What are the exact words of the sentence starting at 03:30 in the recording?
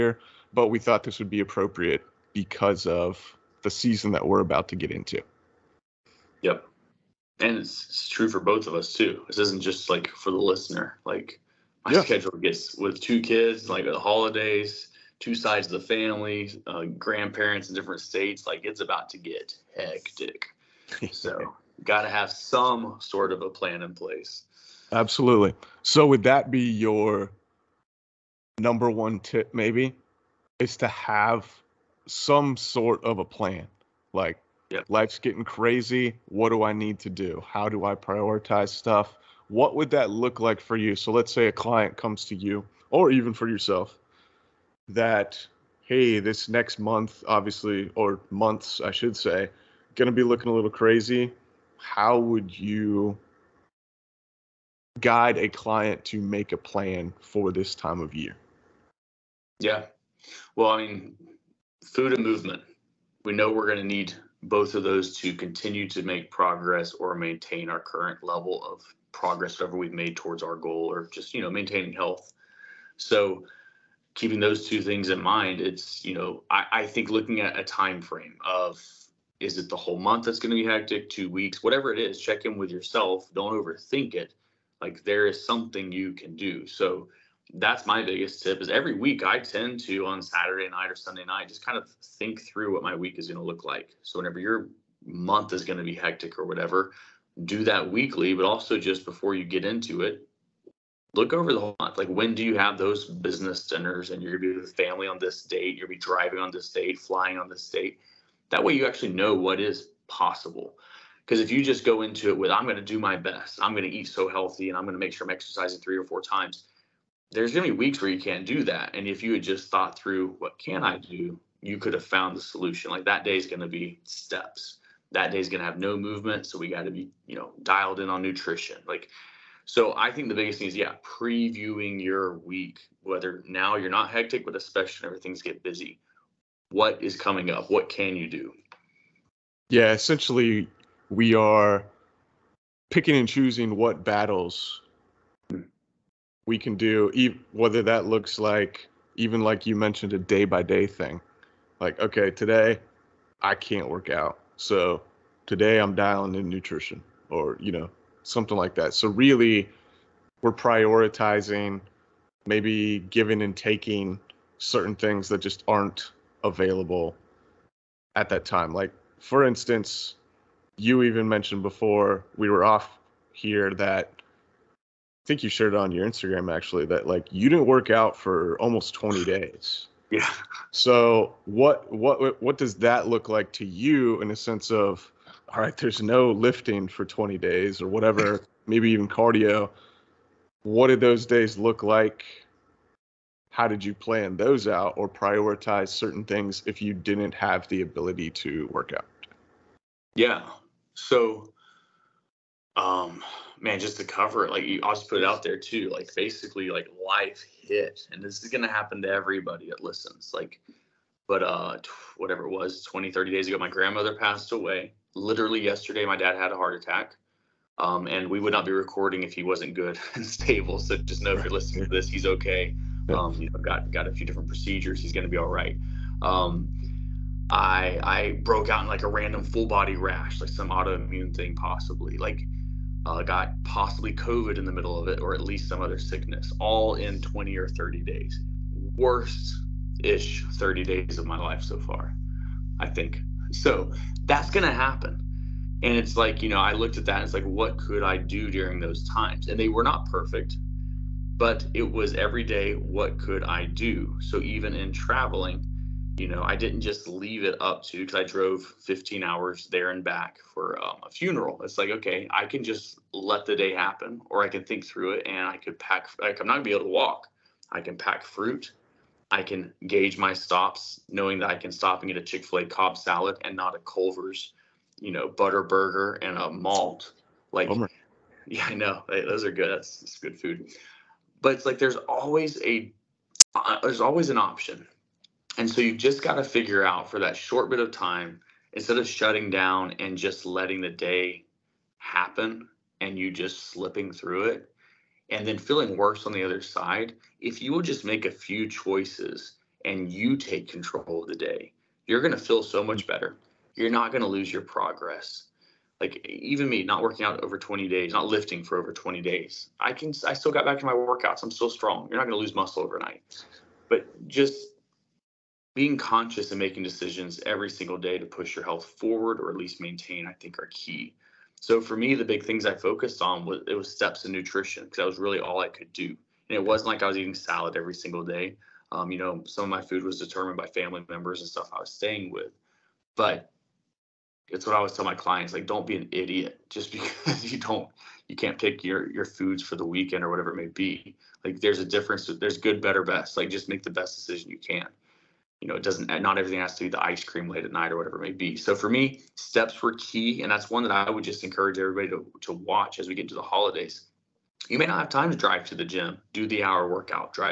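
Like, but uh, whatever it was, 20, 30 days ago, my grandmother passed away.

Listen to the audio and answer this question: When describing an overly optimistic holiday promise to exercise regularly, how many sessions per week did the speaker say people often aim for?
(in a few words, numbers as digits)
3 or 4.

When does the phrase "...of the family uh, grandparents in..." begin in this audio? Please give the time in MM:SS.
00:15.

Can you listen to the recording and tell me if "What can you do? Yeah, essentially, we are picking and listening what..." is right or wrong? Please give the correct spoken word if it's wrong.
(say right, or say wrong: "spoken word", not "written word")
wrong: "choosing", not "listening".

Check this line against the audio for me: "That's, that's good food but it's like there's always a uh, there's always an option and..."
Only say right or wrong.
right.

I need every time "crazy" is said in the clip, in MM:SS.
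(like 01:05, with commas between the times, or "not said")
00:35, 00:50.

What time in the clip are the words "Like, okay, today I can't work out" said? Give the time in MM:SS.
02:31.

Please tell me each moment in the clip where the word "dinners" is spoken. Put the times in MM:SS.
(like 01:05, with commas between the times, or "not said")
01:43.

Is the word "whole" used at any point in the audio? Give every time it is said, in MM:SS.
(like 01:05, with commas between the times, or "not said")
01:19, 01:41.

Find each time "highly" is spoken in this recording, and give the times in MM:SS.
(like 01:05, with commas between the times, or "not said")
not said.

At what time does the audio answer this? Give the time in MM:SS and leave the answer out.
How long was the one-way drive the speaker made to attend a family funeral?
04:18.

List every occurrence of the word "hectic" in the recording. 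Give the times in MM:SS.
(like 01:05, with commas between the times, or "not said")
00:19, 01:20, 01:35, 02:14.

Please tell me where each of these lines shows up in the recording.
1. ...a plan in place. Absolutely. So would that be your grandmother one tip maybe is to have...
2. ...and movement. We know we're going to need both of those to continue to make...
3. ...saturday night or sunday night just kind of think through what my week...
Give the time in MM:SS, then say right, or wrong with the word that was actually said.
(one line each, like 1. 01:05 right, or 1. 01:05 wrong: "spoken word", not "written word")
1. 00:23 wrong: "number", not "grandmother"
2. 01:02 right
3. 01:30 right.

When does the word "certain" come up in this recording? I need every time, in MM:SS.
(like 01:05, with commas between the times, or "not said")
02:44, 03:15.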